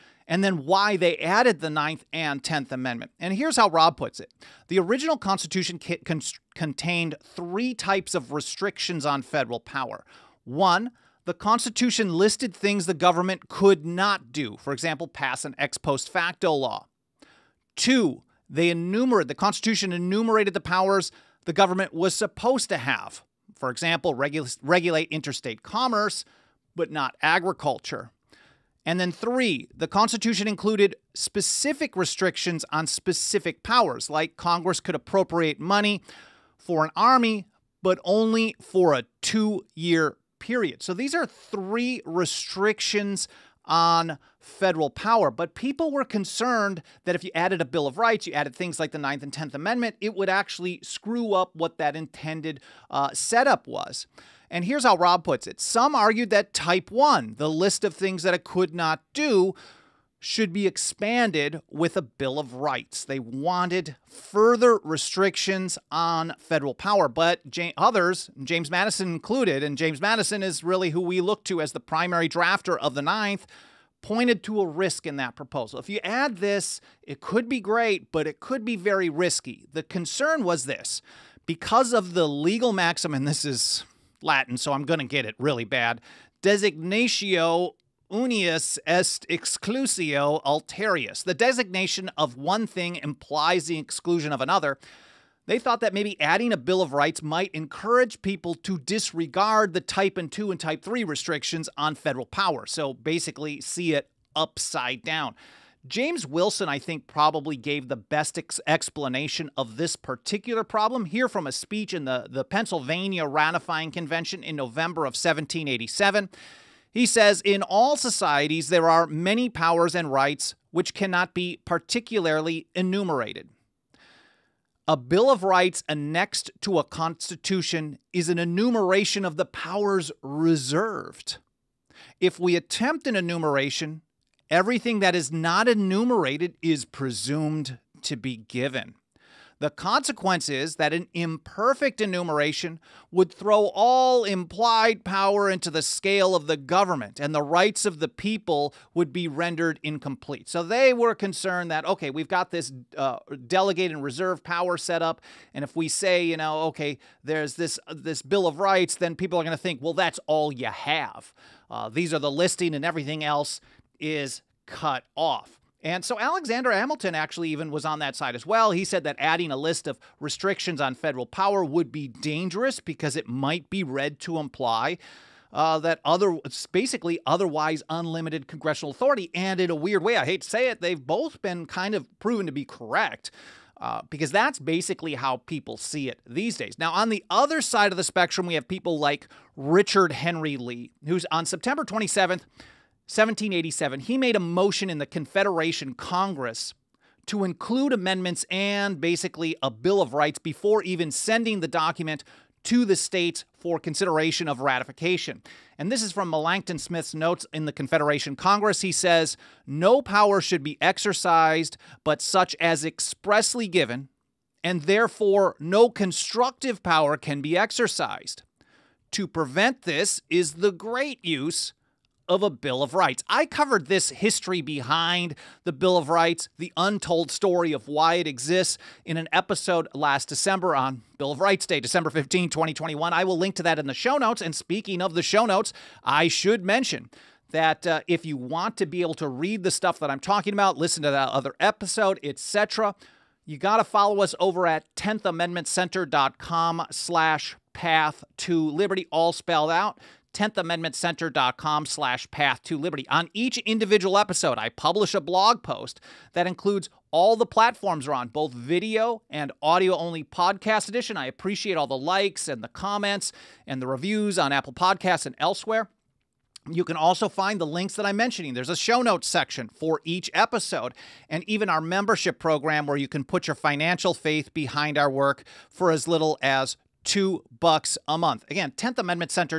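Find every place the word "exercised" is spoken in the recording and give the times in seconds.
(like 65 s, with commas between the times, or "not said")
210 s, 217 s.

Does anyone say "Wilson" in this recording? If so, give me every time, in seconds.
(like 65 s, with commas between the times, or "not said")
106 s.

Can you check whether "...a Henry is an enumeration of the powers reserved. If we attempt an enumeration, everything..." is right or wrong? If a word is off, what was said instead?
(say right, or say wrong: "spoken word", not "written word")
wrong: "Constitution", not "Henry".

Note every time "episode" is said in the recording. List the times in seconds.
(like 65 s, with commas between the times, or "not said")
229 s, 241 s, 254 s, 270 s.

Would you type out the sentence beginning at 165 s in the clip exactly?
And so Alexander Hamilton actually even was on that side as well.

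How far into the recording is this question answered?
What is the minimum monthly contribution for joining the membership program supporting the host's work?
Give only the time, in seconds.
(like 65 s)
277 s.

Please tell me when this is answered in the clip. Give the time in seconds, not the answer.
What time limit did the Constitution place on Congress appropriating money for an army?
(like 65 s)
39 s.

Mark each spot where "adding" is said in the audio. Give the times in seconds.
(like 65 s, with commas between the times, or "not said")
96 s, 169 s.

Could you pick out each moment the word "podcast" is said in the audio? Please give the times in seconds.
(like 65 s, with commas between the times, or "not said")
260 s, 264 s.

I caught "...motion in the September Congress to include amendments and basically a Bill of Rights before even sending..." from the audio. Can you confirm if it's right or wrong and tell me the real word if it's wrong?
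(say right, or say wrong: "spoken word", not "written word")
wrong: "Confederation", not "September".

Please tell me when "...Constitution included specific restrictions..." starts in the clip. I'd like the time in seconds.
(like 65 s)
29 s.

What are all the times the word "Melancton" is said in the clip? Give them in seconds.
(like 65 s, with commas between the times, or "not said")
206 s.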